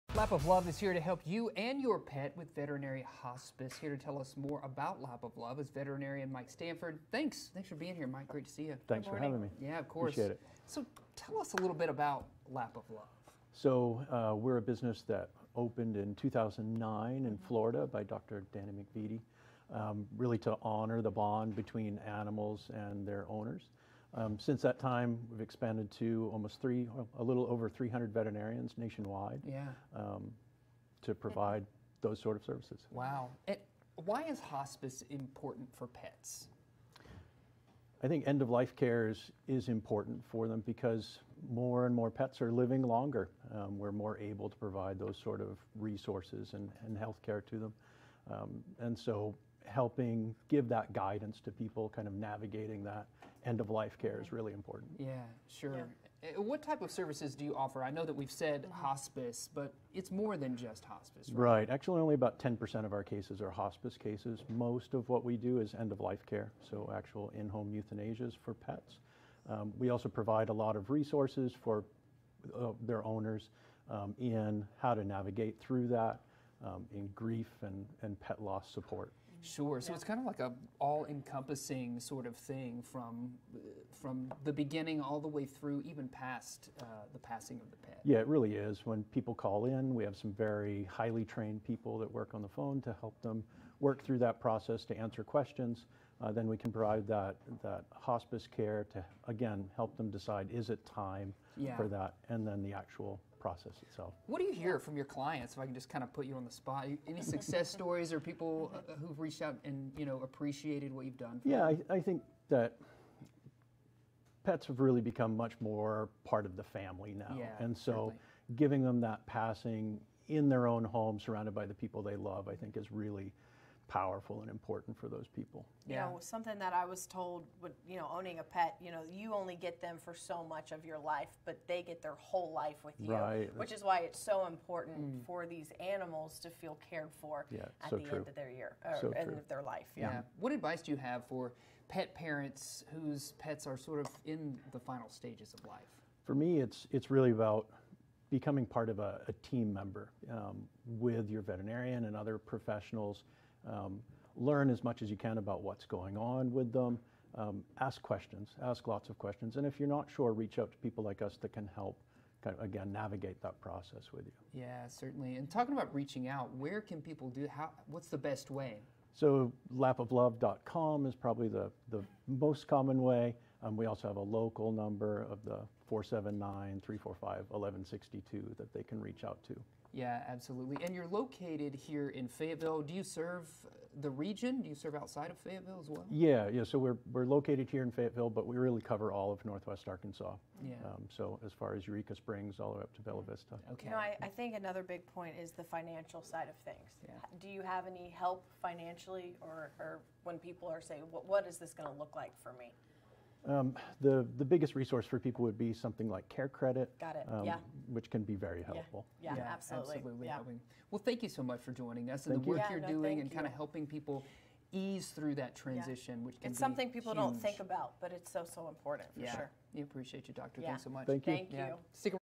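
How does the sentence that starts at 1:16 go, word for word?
Um, in grief and, and pet loss support.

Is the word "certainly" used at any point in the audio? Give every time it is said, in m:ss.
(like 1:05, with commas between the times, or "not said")
1:57, 2:44.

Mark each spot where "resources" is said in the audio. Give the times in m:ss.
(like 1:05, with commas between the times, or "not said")
0:45, 1:10, 3:24.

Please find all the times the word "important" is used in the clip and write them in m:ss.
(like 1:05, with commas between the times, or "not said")
0:35, 0:39, 0:54, 2:04, 2:14, 3:38.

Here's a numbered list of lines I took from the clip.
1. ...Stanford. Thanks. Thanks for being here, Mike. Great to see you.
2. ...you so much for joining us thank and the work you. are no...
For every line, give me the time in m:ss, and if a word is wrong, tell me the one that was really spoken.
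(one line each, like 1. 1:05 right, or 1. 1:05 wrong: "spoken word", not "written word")
1. 0:06 right
2. 3:31 right.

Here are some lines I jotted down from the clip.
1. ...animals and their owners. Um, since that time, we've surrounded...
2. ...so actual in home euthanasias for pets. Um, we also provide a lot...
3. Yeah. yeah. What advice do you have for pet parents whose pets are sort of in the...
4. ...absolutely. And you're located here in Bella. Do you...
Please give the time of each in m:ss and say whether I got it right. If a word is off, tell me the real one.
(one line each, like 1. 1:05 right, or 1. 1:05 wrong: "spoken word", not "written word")
1. 0:22 wrong: "expanded", not "surrounded"
2. 1:06 right
3. 2:19 right
4. 3:00 wrong: "Fayetteville", not "Bella".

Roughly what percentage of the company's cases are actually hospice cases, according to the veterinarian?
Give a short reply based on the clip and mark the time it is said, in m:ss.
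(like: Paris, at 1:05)
10%, at 1:02.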